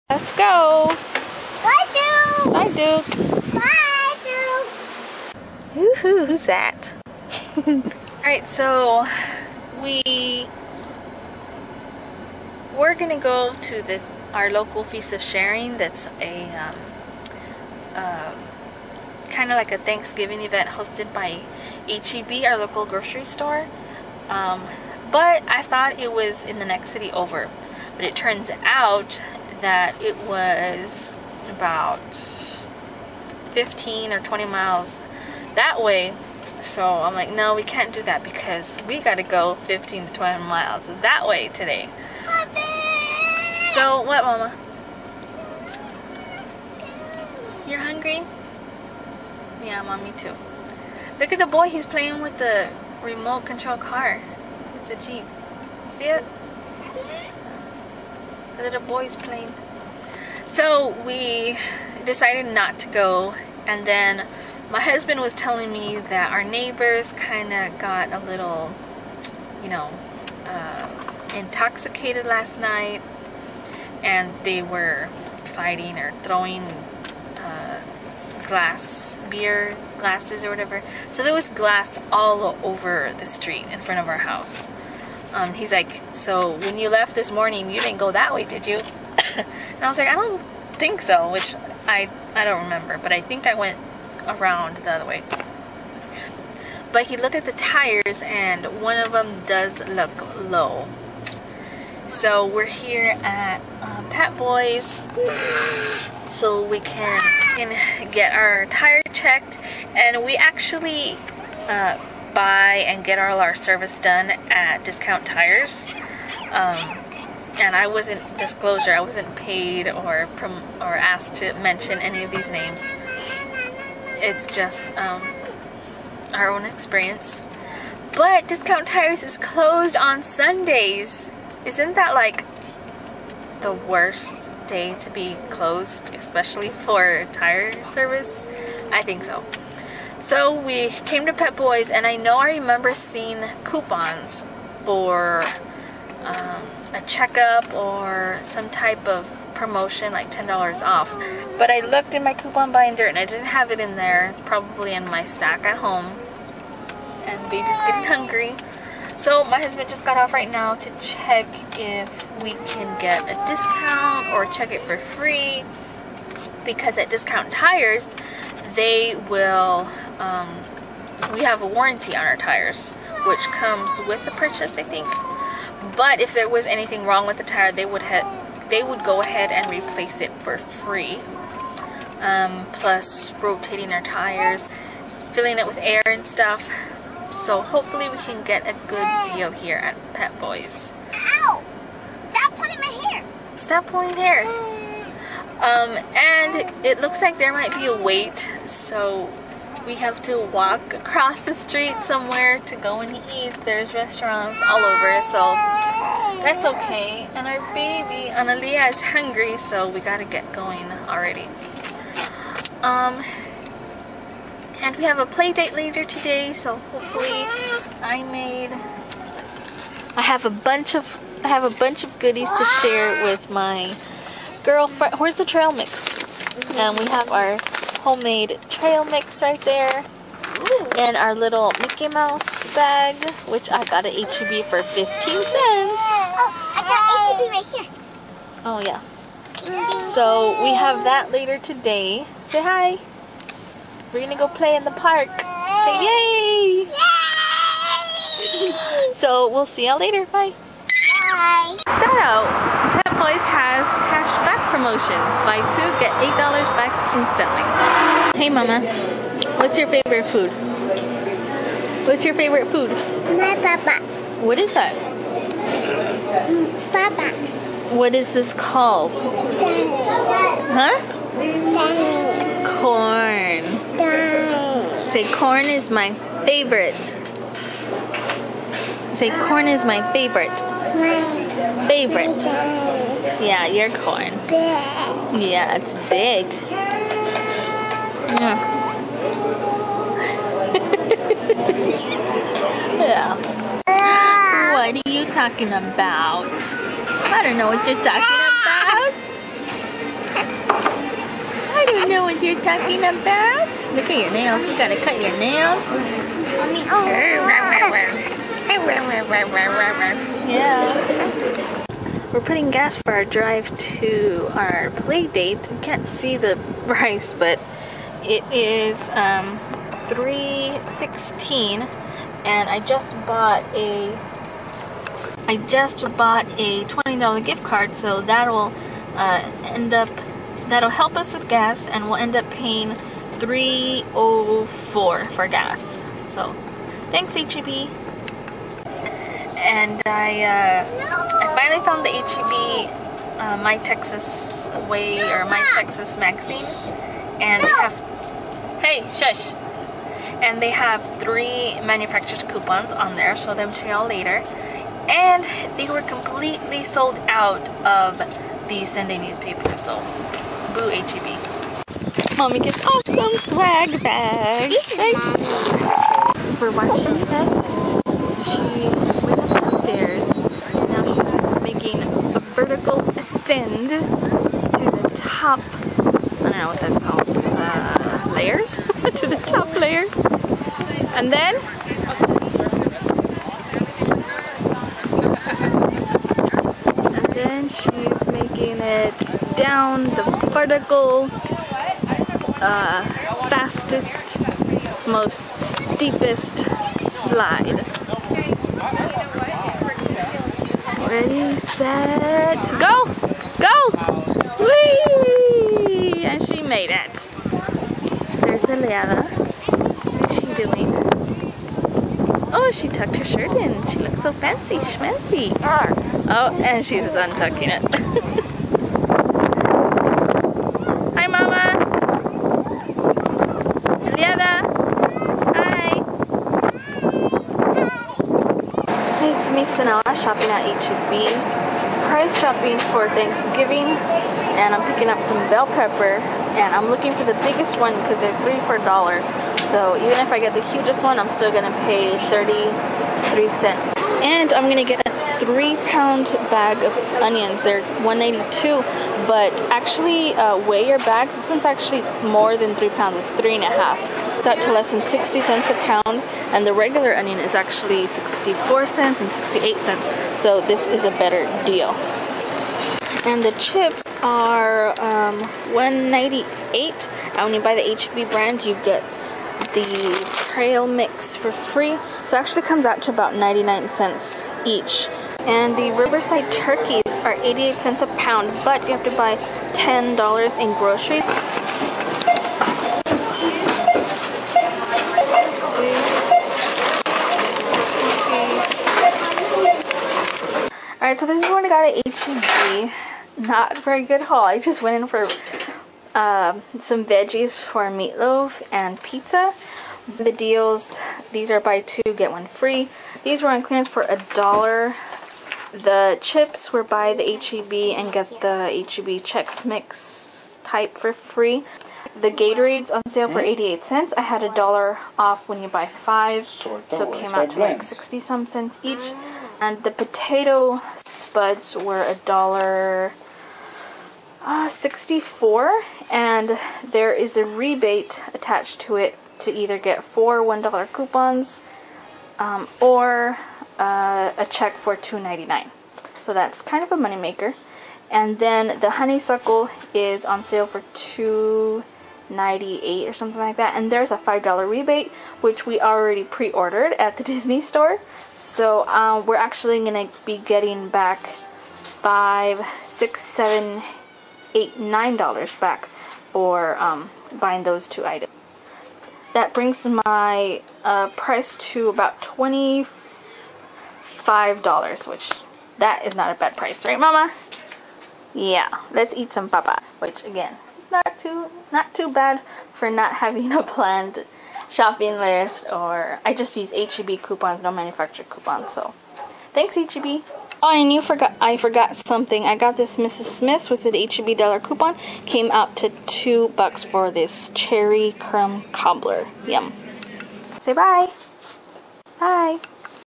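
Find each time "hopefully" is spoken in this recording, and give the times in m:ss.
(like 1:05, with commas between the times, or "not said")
3:07, 3:36.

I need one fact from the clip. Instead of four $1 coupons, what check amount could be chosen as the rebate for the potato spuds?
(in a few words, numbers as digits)
$2.99.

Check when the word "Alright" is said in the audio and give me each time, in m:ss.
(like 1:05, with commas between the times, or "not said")
0:08, 8:11.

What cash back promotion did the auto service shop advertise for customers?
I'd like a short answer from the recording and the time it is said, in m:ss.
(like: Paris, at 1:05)
Buy two, get $8 back, at 4:15.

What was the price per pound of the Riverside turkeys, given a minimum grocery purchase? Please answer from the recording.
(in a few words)
88 cents.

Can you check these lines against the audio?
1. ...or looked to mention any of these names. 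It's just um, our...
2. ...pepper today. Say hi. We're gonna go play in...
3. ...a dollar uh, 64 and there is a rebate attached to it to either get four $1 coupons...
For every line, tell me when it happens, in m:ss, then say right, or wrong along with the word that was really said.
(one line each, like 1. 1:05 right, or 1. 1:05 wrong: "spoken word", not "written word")
1. 2:00 wrong: "asked", not "looked"
2. 4:01 wrong: "later", not "pepper"
3. 8:42 right.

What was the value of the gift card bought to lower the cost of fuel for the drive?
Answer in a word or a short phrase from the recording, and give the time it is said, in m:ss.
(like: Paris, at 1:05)
$20, at 5:26.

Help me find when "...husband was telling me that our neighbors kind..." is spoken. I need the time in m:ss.
1:04.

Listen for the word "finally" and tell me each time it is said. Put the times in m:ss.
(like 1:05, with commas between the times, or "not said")
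5:41.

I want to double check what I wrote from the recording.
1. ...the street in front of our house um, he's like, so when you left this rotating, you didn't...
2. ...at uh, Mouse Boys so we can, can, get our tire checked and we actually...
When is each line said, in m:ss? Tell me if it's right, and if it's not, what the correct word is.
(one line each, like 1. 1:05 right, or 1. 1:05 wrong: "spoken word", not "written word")
1. 1:23 wrong: "morning", not "rotating"
2. 1:43 wrong: "Pep", not "Mouse".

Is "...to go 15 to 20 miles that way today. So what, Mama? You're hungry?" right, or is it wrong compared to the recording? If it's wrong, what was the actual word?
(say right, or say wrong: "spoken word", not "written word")
right.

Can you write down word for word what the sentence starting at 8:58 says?
And then the honeysuckle is on sale for $2.98 or something like that.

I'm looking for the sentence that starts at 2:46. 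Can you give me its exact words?
Because at Discount Tires, they will um, we have a warranty on our tires, which comes with the purchase, I think.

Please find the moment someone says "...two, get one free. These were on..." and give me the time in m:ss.
8:21.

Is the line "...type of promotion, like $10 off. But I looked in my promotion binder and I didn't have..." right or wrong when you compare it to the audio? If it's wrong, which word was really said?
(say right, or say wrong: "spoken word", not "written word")
wrong: "coupon", not "promotion".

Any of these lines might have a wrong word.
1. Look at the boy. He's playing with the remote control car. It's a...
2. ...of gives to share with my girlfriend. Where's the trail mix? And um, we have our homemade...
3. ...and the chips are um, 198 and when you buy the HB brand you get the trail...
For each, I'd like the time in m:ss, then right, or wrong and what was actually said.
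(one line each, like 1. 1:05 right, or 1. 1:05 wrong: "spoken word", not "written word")
1. 0:51 right
2. 3:42 wrong: "goodies", not "gives"
3. 7:43 right.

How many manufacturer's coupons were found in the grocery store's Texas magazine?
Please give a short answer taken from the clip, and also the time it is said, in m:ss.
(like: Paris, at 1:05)
3, at 5:51.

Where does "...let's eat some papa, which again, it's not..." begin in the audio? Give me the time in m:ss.
9:28.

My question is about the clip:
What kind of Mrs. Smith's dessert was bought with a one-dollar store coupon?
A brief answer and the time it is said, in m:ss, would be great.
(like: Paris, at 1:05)
Cherry crumb cobbler, at 9:47.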